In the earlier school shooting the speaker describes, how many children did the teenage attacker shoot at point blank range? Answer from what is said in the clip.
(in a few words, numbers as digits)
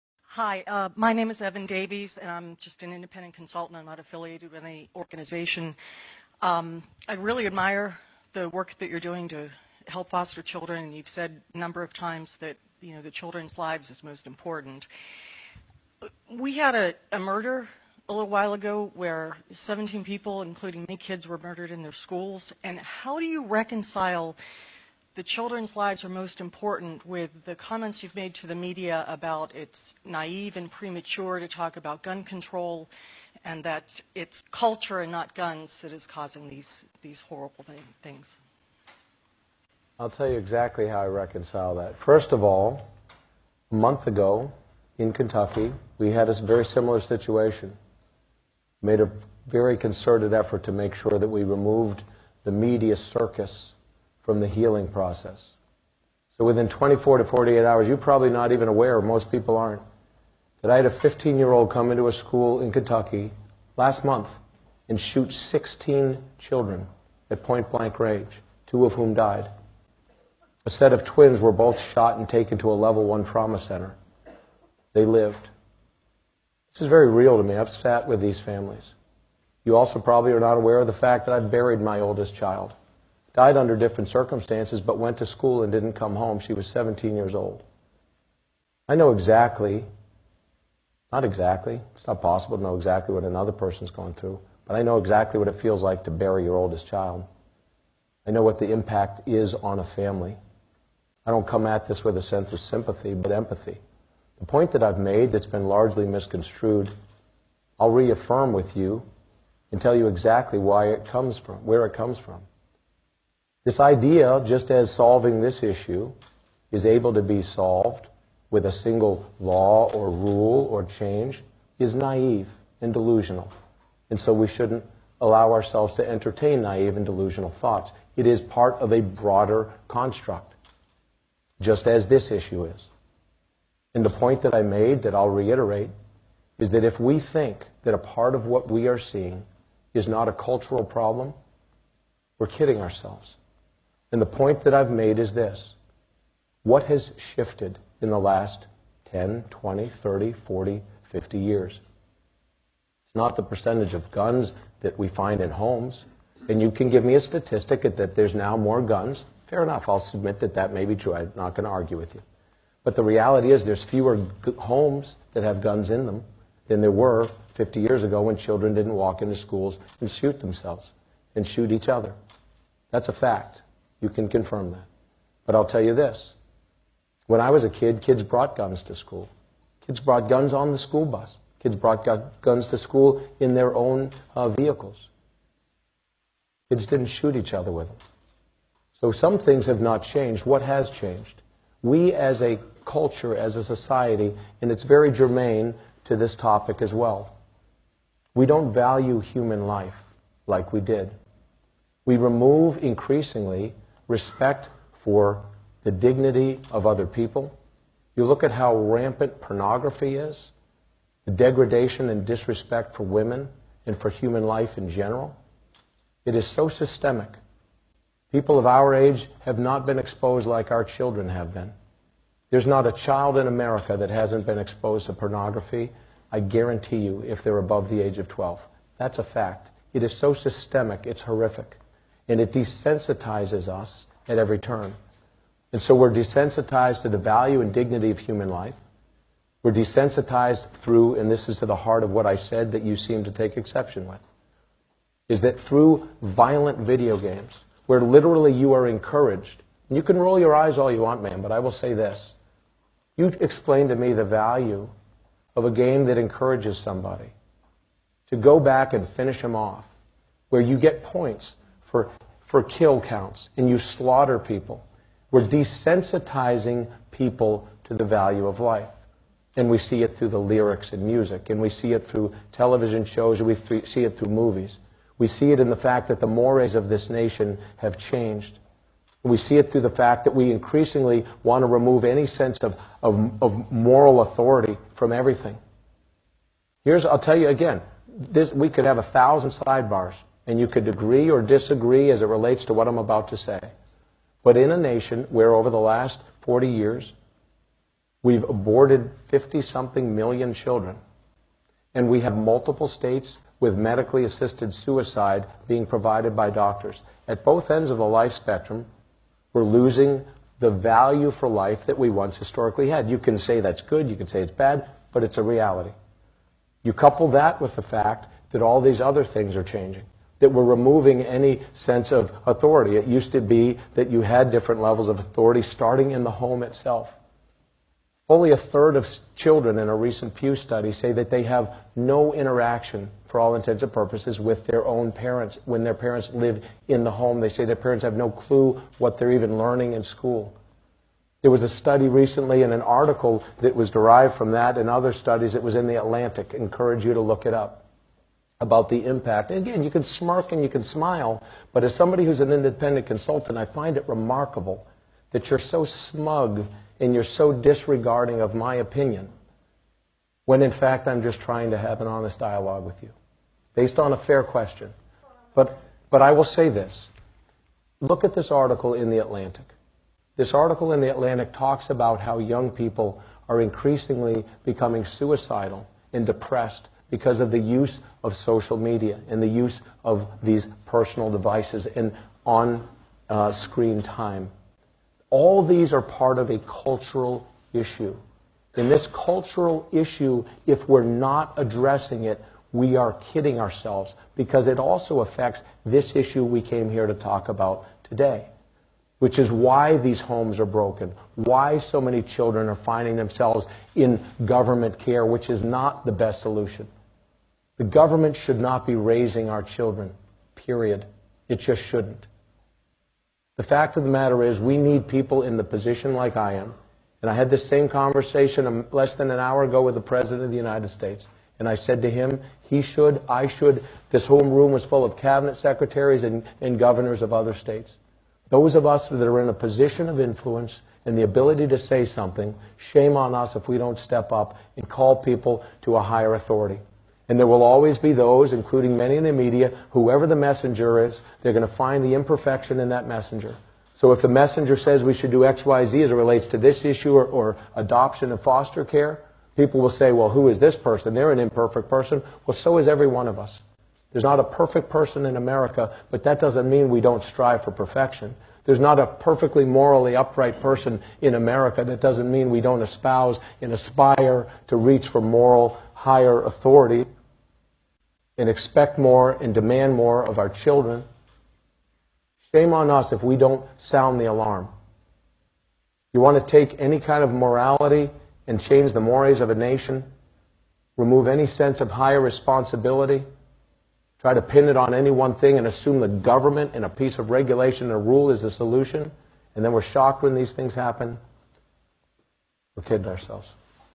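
16.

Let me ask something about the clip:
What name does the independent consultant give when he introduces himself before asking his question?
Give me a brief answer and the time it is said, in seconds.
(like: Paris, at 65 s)
Evan Davies, at 1 s.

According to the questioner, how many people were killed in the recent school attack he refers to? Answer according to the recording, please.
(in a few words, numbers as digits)
17.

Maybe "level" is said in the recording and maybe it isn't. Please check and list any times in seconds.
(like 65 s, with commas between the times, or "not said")
72 s, 324 s.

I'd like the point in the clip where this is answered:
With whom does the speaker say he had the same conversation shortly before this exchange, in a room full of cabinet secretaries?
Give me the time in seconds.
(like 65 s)
420 s.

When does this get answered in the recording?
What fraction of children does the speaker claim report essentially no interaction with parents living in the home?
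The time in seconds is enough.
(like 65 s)
328 s.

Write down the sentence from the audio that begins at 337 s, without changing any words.
They say their parents have no clue what they're even learning in school.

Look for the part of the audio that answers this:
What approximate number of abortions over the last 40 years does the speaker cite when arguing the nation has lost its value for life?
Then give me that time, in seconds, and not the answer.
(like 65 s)
299 s.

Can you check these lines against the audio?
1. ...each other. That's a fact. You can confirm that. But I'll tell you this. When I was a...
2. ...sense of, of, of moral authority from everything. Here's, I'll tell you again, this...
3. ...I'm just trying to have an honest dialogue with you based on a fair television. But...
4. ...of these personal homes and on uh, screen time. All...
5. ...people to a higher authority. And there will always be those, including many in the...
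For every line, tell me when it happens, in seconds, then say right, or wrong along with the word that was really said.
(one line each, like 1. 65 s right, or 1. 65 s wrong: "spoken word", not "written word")
1. 171 s right
2. 282 s right
3. 361 s wrong: "question", not "television"
4. 380 s wrong: "devices", not "homes"
5. 435 s right.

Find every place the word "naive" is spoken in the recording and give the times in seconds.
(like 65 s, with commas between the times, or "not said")
30 s, 121 s, 126 s.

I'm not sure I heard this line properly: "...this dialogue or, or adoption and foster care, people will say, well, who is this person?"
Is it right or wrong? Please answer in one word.
wrong.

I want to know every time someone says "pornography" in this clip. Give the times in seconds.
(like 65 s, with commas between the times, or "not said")
209 s, 225 s.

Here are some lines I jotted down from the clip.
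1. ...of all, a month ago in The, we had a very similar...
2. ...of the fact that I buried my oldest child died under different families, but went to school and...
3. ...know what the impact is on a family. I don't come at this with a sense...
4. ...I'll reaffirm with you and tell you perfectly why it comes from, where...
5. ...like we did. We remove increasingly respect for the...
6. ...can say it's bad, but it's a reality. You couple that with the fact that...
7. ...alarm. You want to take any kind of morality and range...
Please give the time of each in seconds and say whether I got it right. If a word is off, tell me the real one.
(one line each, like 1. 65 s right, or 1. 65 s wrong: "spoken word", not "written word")
1. 42 s wrong: "Kentucky", not "The"
2. 80 s wrong: "circumstances", not "families"
3. 98 s right
4. 107 s wrong: "exactly", not "perfectly"
5. 200 s right
6. 314 s right
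7. 474 s wrong: "change", not "range".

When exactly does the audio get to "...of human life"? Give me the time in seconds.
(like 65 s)
238 s.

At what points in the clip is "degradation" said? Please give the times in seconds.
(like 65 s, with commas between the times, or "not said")
211 s.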